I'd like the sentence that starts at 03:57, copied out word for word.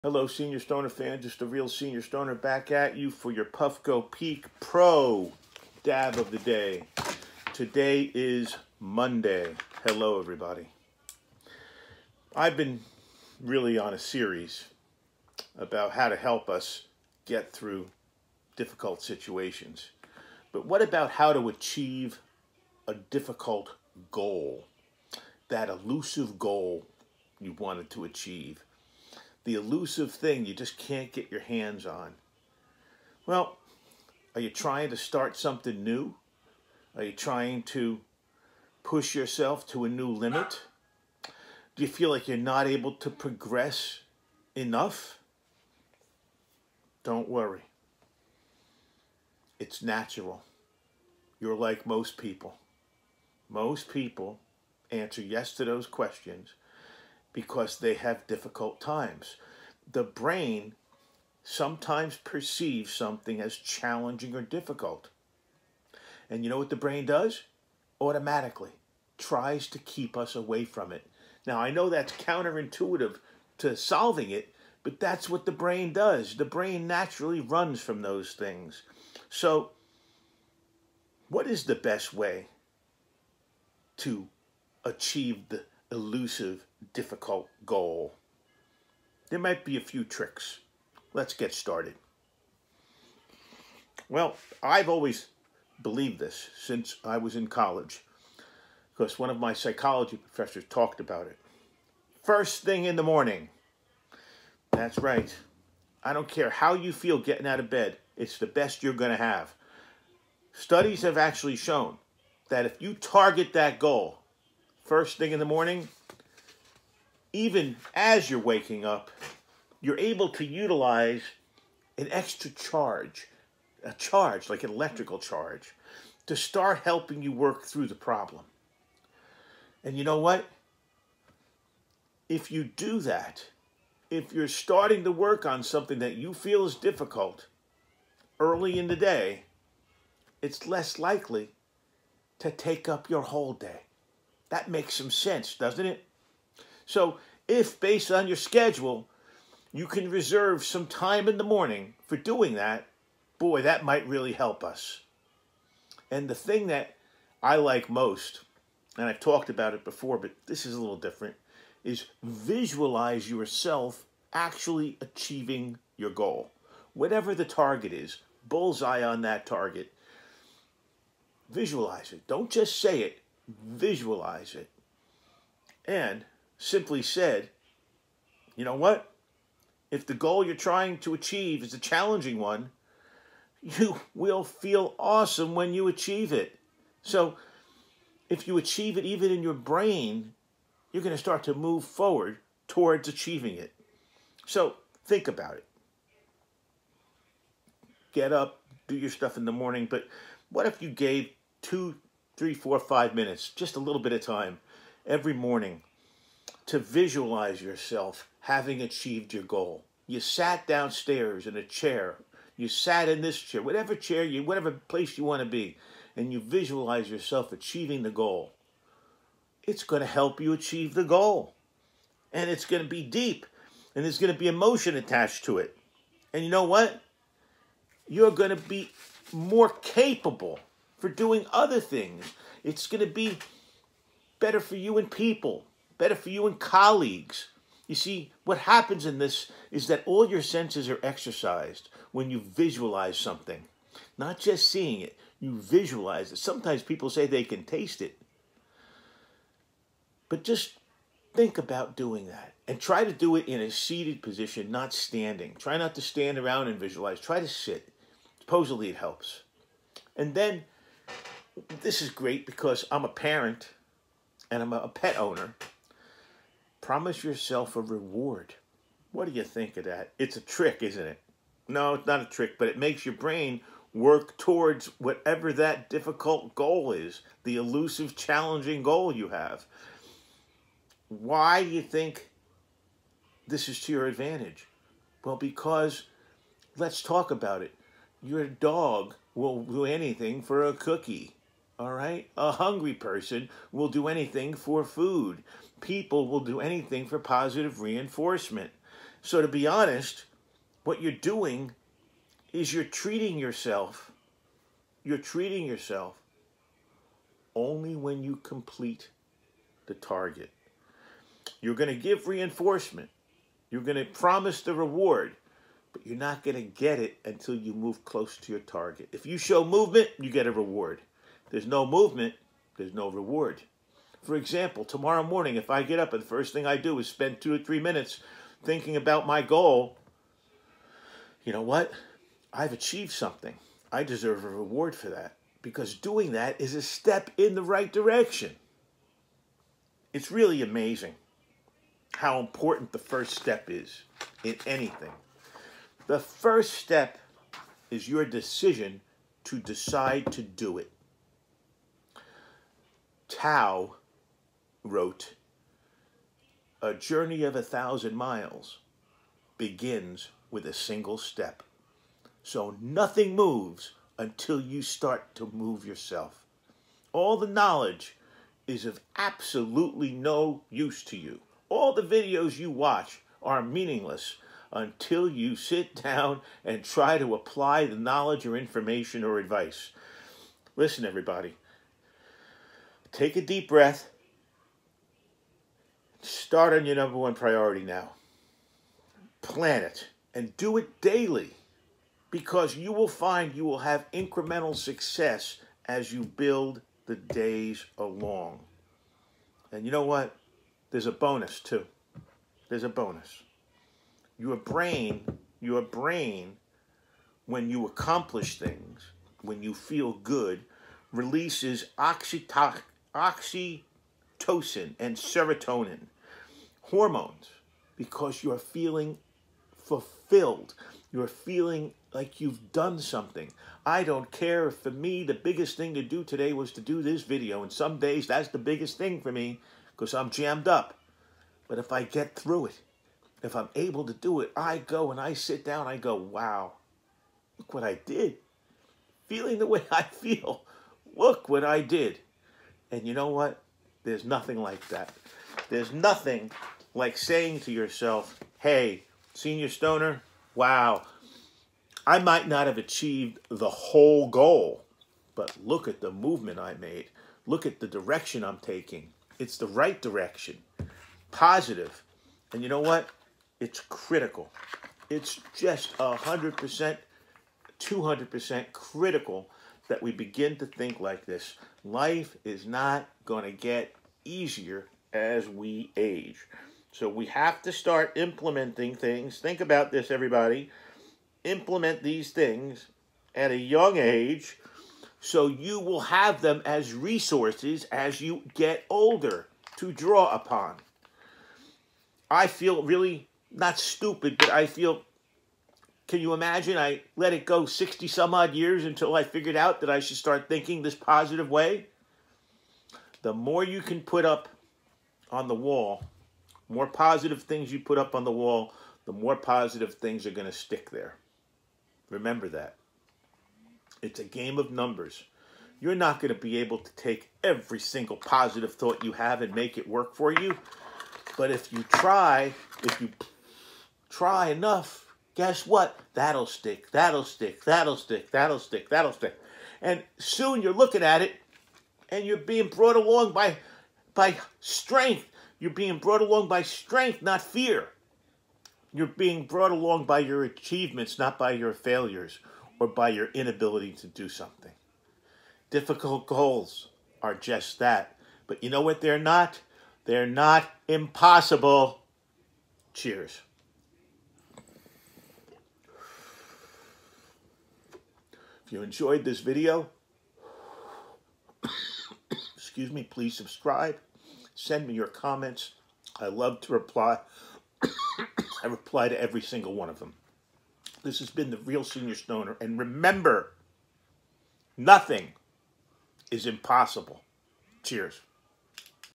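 You see, what happens in this is that all your senses are exercised when you visualize something.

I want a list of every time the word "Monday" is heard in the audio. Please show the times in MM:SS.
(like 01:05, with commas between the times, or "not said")
00:08.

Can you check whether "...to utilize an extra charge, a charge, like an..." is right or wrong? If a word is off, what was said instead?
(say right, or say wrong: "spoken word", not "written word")
right.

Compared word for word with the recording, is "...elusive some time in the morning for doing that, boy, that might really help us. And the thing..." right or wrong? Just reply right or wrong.
wrong.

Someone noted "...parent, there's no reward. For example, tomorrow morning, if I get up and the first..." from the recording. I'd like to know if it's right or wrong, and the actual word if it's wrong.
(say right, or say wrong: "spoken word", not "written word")
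wrong: "movement", not "parent".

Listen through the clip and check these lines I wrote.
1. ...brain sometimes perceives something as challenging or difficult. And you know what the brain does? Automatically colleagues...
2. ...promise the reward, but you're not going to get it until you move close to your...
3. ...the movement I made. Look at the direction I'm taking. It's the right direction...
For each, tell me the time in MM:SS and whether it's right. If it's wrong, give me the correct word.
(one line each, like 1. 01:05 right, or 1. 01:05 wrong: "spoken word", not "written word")
1. 01:00 wrong: "tries", not "colleagues"
2. 05:14 right
3. 07:36 right.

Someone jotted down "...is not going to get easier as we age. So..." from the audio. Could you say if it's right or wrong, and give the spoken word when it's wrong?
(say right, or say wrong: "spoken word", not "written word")
right.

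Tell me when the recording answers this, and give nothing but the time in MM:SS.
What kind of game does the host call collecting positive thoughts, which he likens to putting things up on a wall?
08:34.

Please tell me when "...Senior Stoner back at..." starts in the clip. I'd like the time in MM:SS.
00:01.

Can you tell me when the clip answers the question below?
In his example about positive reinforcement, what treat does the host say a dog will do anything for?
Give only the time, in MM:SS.
04:50.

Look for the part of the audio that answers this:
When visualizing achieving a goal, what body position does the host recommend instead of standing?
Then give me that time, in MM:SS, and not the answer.
04:13.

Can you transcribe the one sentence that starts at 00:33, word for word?
Well, are you trying to start something new?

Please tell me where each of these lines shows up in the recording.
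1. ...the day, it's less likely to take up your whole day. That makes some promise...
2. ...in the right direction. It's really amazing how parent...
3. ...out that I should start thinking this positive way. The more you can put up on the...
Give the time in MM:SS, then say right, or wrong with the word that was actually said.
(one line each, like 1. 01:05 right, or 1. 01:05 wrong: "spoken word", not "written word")
1. 02:18 wrong: "sense", not "promise"
2. 05:37 wrong: "important", not "parent"
3. 08:19 right.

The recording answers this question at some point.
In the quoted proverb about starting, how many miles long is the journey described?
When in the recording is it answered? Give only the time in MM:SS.
05:57.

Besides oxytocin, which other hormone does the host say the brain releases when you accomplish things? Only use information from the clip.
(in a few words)
serotonin.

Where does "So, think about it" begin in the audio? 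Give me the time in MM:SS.
03:14.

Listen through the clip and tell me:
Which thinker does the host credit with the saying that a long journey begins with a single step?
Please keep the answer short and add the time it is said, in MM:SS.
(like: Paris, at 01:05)
Tao, at 05:53.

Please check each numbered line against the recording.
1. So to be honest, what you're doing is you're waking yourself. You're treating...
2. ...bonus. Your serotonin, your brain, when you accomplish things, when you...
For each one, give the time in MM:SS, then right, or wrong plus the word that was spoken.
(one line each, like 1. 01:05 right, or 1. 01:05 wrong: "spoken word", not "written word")
1. 04:59 wrong: "treating", not "waking"
2. 06:42 wrong: "brain", not "serotonin".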